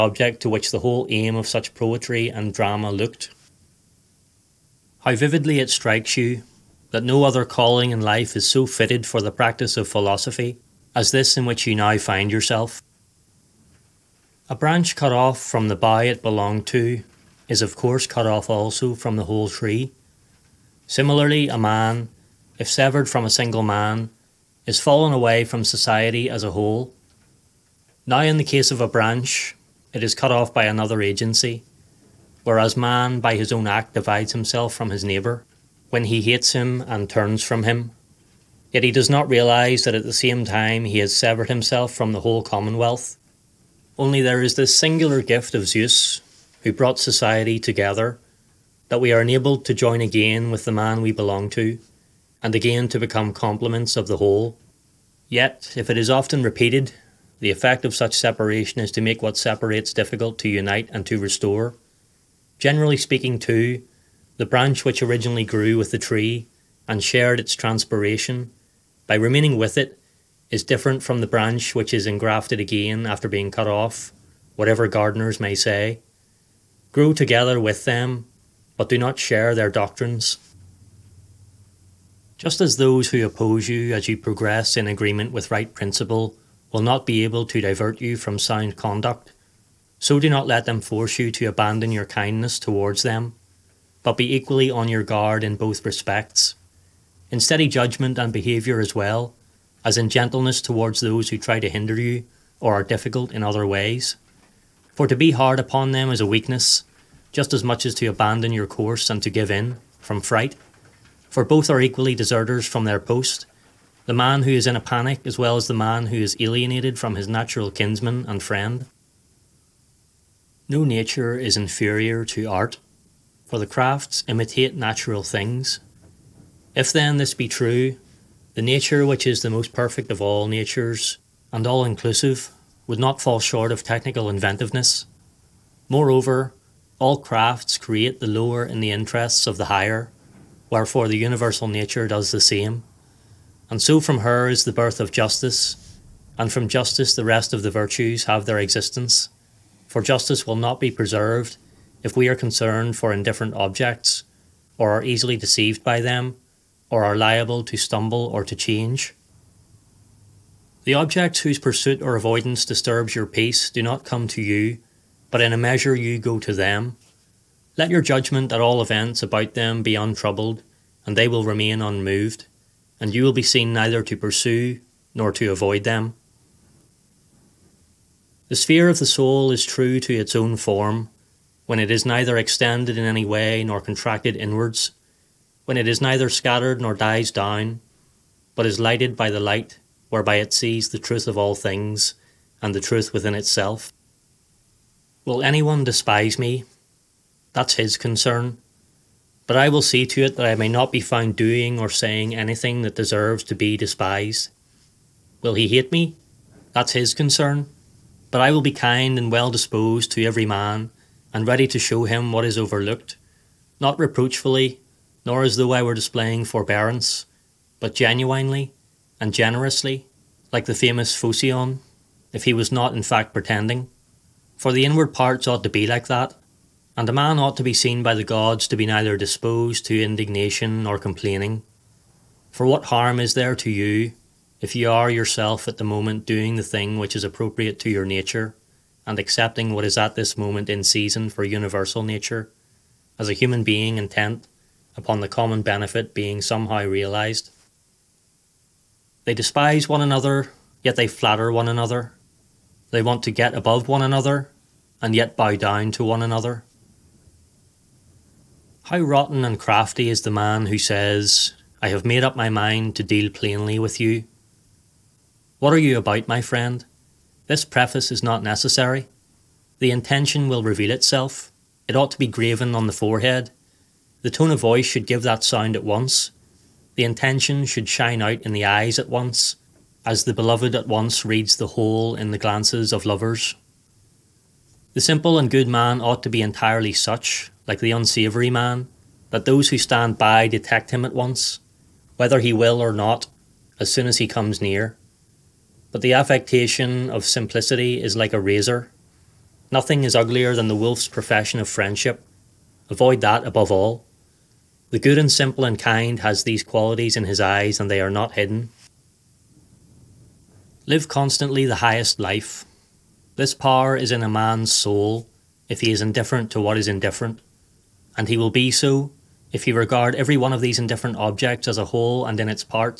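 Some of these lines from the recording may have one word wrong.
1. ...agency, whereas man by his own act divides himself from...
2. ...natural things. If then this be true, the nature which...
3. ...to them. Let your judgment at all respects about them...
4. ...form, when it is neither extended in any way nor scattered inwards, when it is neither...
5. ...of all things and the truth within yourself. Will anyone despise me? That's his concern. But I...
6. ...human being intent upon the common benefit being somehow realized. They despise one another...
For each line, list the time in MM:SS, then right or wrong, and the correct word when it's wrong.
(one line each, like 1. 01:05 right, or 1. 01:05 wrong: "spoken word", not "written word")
1. 00:31 right
2. 02:04 right
3. 02:46 wrong: "events", not "respects"
4. 03:00 wrong: "contracted", not "scattered"
5. 03:11 wrong: "itself", not "yourself"
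6. 04:03 right.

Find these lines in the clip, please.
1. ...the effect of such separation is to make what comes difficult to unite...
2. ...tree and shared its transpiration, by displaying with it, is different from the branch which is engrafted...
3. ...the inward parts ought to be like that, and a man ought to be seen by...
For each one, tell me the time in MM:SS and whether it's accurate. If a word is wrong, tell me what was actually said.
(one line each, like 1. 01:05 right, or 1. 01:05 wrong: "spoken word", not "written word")
1. 00:57 wrong: "separates", not "comes"
2. 01:05 wrong: "remaining", not "displaying"
3. 03:44 right.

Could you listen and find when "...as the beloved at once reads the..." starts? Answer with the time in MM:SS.
04:40.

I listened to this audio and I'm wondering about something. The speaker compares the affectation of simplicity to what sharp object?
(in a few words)
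a razor.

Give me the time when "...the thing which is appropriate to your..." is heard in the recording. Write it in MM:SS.
03:56.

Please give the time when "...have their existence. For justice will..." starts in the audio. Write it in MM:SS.
02:28.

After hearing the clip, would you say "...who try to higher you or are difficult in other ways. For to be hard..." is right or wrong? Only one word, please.
wrong.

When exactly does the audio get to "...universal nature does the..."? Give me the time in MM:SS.
02:21.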